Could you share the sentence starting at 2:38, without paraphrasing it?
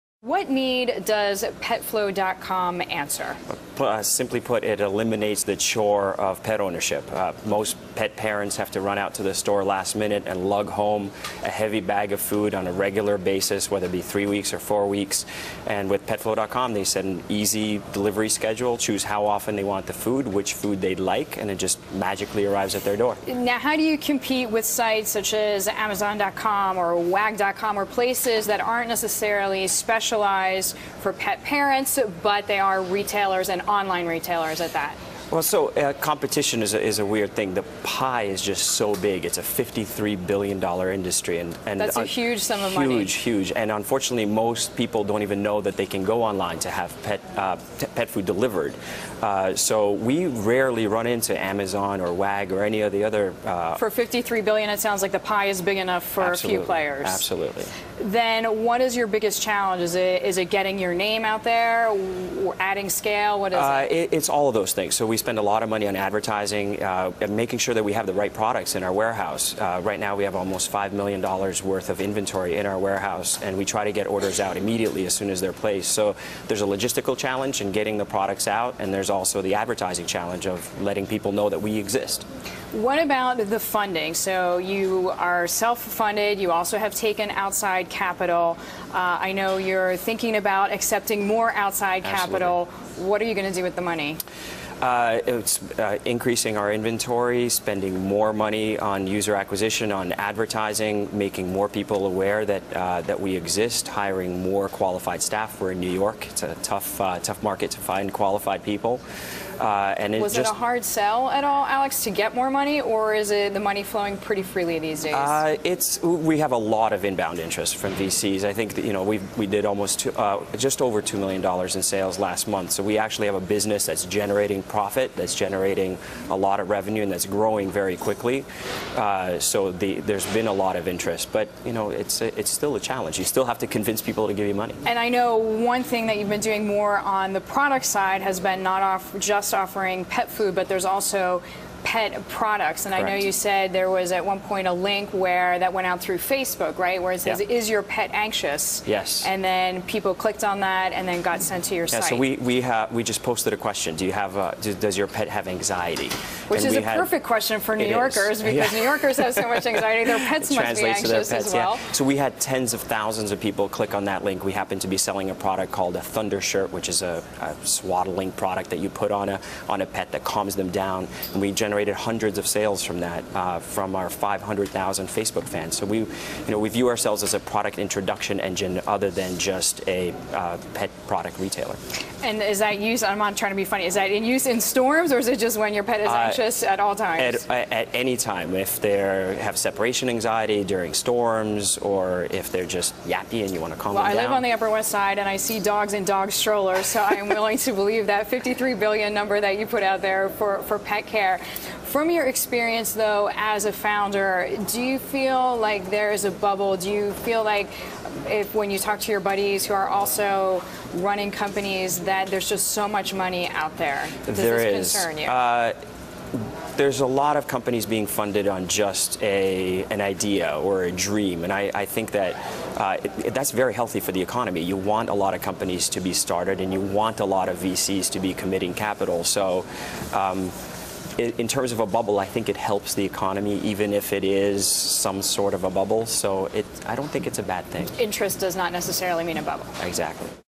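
New Yorkers have so much anxiety.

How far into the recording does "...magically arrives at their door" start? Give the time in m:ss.
0:21.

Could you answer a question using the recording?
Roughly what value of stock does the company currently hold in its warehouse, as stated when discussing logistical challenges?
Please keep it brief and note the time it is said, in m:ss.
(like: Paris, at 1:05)
almost $5 million, at 1:10.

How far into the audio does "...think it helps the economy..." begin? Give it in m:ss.
3:52.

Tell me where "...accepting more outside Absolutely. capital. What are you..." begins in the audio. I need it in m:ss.
1:30.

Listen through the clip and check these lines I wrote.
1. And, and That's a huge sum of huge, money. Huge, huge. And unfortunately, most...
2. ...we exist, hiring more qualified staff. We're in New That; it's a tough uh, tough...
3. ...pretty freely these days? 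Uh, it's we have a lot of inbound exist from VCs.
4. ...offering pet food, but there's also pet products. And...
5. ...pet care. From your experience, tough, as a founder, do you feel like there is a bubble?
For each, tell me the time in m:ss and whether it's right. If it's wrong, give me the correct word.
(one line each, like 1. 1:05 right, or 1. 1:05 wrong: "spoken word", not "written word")
1. 0:41 right
2. 1:43 wrong: "York", not "That"
3. 1:54 wrong: "interest", not "exist"
4. 2:19 right
5. 3:20 wrong: "though", not "tough".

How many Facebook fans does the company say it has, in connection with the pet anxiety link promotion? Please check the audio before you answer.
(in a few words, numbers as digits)
500,000.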